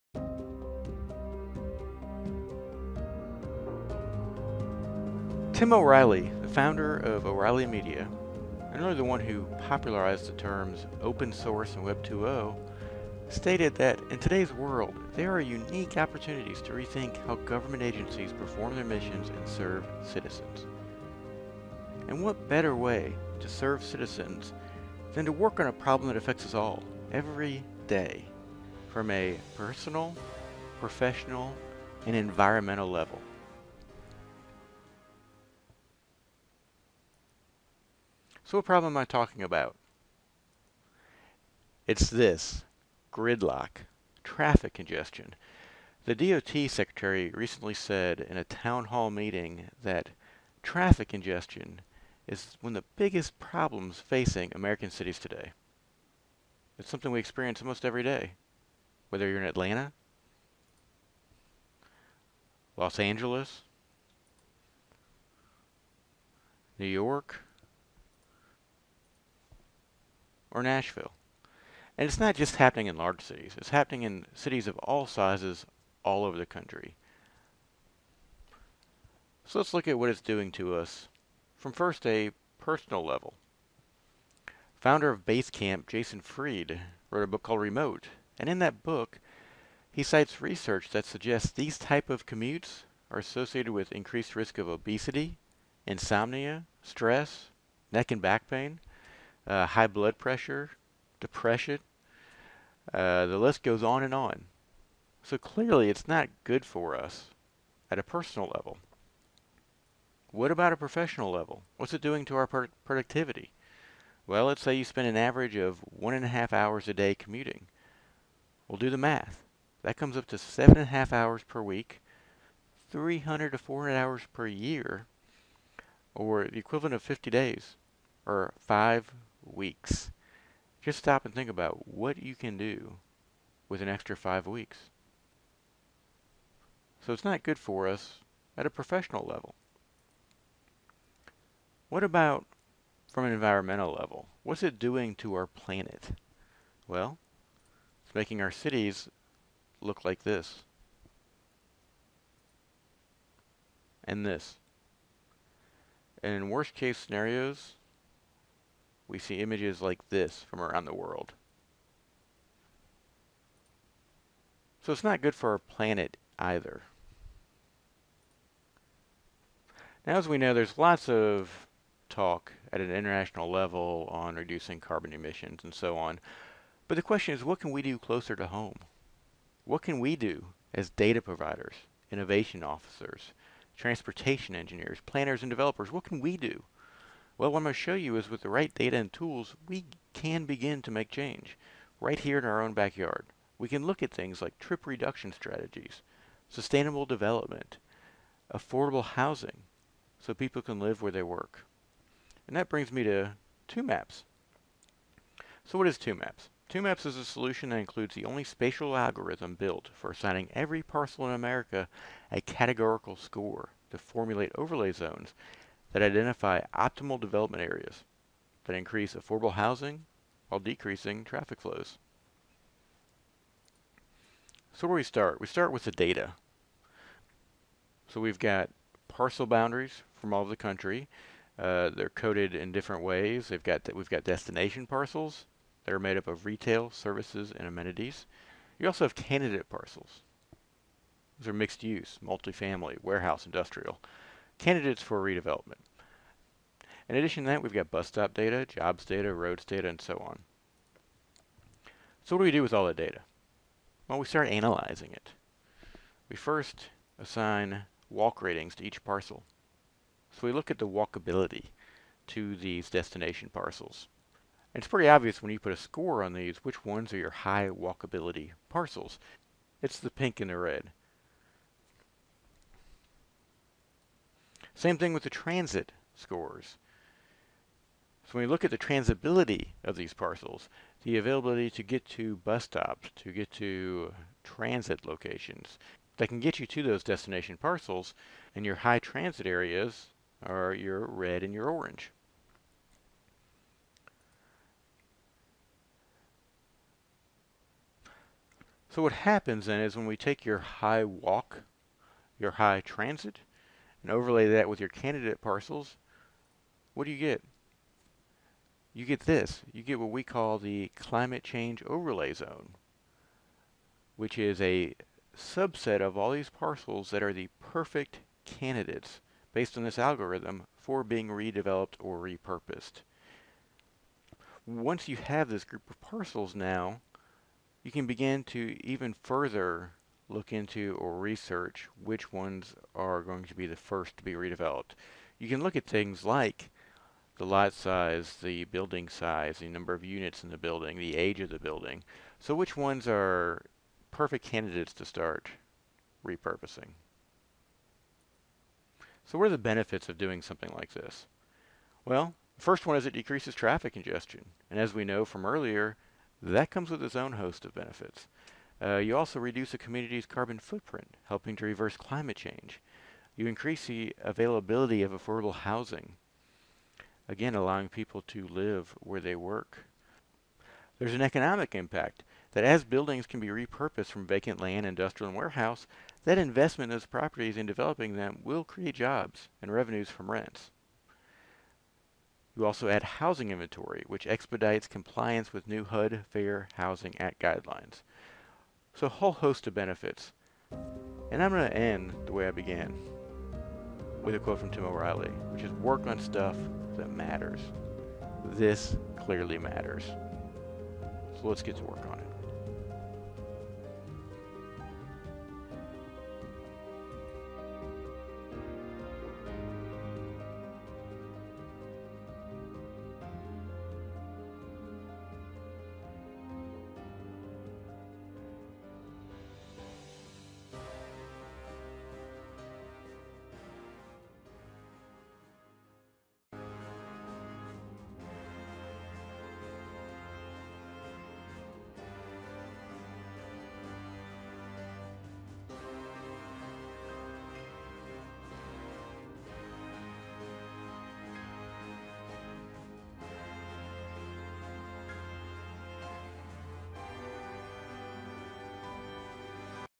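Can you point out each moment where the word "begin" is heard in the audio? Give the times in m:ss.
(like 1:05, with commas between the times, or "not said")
3:10, 5:28.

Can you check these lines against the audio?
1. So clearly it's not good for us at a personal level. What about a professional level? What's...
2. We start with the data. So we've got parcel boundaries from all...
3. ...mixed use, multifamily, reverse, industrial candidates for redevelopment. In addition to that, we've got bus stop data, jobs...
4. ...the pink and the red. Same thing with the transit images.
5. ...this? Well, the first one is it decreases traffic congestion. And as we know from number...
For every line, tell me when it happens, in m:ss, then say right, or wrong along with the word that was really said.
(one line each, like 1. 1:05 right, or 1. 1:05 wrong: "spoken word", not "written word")
1. 1:45 right
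2. 3:45 right
3. 4:01 wrong: "warehouse", not "reverse"
4. 4:29 wrong: "scores", not "images"
5. 5:50 wrong: "earlier", not "number".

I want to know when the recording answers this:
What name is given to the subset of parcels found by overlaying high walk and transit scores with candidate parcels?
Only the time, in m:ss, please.
5:10.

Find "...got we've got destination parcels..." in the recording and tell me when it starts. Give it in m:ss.
3:53.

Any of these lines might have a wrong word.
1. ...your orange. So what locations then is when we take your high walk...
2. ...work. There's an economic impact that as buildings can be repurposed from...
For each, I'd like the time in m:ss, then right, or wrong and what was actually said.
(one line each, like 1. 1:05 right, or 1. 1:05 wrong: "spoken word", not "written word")
1. 4:51 wrong: "happens", not "locations"
2. 6:09 right.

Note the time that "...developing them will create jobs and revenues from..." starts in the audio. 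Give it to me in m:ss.
6:17.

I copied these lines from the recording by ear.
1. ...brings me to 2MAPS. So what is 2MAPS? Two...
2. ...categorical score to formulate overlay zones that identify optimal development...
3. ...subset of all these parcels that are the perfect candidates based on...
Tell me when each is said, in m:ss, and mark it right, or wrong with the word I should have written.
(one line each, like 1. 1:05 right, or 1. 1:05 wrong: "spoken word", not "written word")
1. 3:22 right
2. 3:32 right
3. 5:15 right.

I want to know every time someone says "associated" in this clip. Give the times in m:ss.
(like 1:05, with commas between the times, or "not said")
1:33.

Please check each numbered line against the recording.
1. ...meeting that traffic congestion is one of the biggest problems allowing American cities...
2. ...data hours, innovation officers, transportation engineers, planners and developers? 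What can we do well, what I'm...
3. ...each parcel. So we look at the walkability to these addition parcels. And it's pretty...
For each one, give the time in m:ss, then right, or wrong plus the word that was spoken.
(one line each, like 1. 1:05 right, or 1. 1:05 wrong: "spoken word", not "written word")
1. 0:49 wrong: "facing", not "allowing"
2. 3:00 wrong: "providers", not "hours"
3. 4:18 wrong: "destination", not "addition".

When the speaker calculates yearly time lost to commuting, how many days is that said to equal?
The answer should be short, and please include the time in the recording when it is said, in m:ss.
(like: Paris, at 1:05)
50 days, at 2:07.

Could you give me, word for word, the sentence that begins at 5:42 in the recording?
So which ones are perfect candidates to start repurposing?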